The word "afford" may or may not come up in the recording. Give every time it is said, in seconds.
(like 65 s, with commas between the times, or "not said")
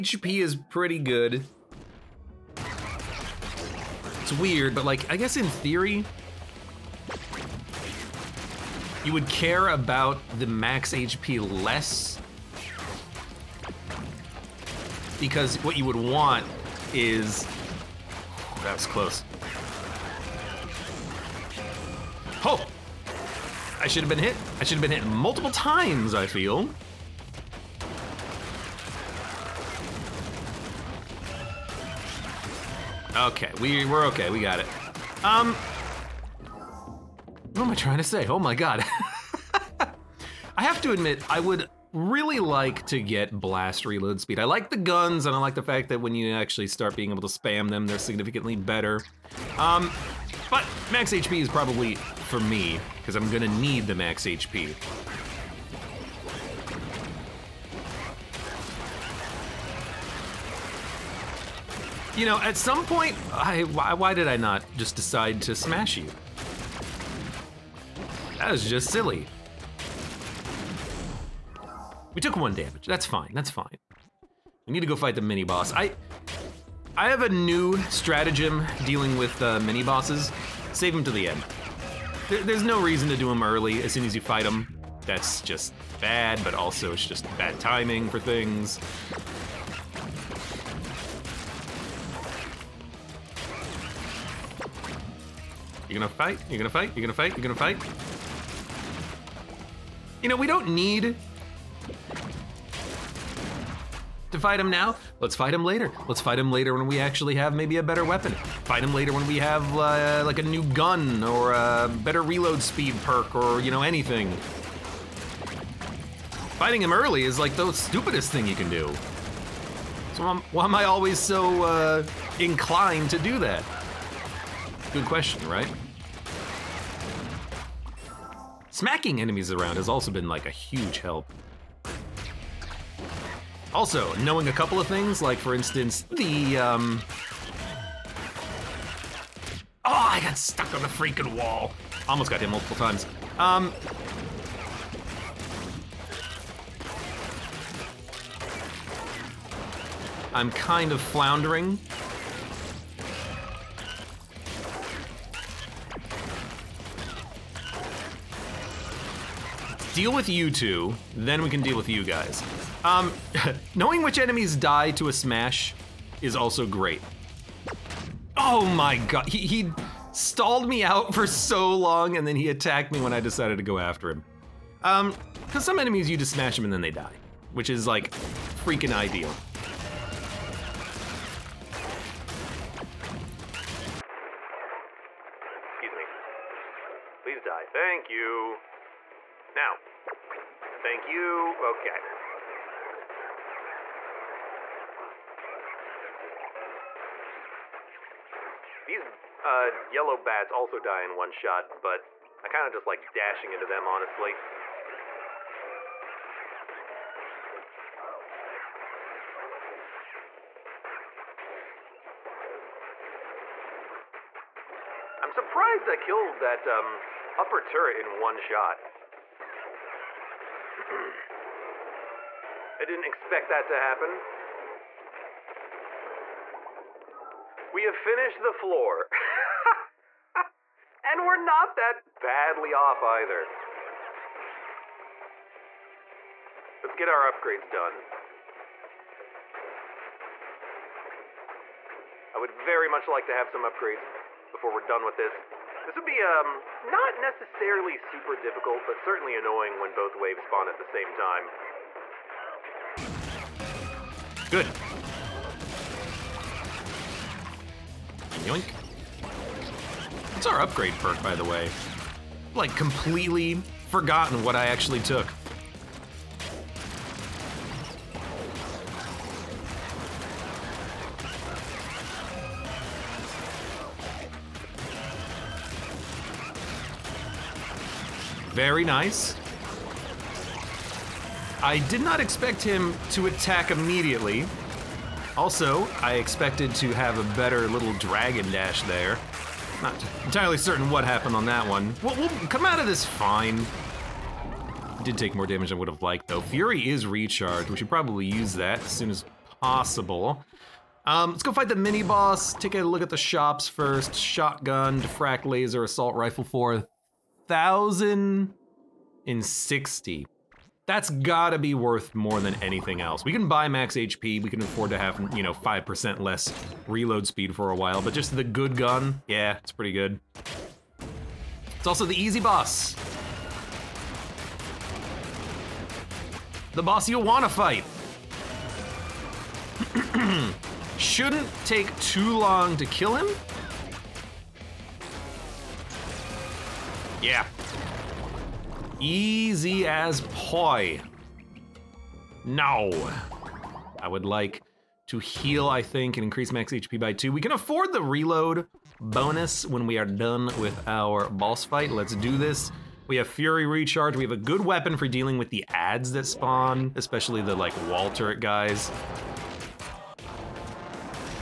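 314 s, 347 s.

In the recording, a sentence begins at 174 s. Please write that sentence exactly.
Um, cause some enemies you just smash them and then they die, which is like freaking ideal.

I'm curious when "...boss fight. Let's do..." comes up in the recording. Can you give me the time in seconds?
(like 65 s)
351 s.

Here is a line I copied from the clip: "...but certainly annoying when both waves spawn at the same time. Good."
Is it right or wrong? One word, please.
right.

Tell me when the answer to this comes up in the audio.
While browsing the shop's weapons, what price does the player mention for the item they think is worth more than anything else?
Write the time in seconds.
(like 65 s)
307 s.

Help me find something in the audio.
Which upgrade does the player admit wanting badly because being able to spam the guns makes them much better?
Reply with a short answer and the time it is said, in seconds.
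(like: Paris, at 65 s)
Blast reload speed, at 43 s.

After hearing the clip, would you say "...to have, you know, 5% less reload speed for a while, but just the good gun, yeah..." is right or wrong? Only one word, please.
right.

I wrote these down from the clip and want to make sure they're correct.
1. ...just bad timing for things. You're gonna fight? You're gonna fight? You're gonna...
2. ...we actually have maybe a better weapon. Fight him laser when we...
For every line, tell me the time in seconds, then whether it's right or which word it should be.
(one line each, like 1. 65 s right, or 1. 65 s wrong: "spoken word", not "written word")
1. 87 s right
2. 106 s wrong: "later", not "laser".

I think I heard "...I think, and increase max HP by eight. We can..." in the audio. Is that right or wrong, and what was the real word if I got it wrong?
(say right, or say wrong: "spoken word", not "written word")
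wrong: "two", not "eight".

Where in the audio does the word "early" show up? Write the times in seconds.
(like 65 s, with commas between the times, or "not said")
83 s, 116 s.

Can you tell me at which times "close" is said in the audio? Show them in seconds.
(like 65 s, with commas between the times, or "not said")
18 s.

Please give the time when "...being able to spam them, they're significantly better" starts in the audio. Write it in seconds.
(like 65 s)
46 s.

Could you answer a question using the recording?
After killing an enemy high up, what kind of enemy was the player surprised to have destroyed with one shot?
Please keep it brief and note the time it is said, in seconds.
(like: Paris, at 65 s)
Upper turret, at 217 s.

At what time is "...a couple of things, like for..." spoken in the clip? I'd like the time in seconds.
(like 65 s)
134 s.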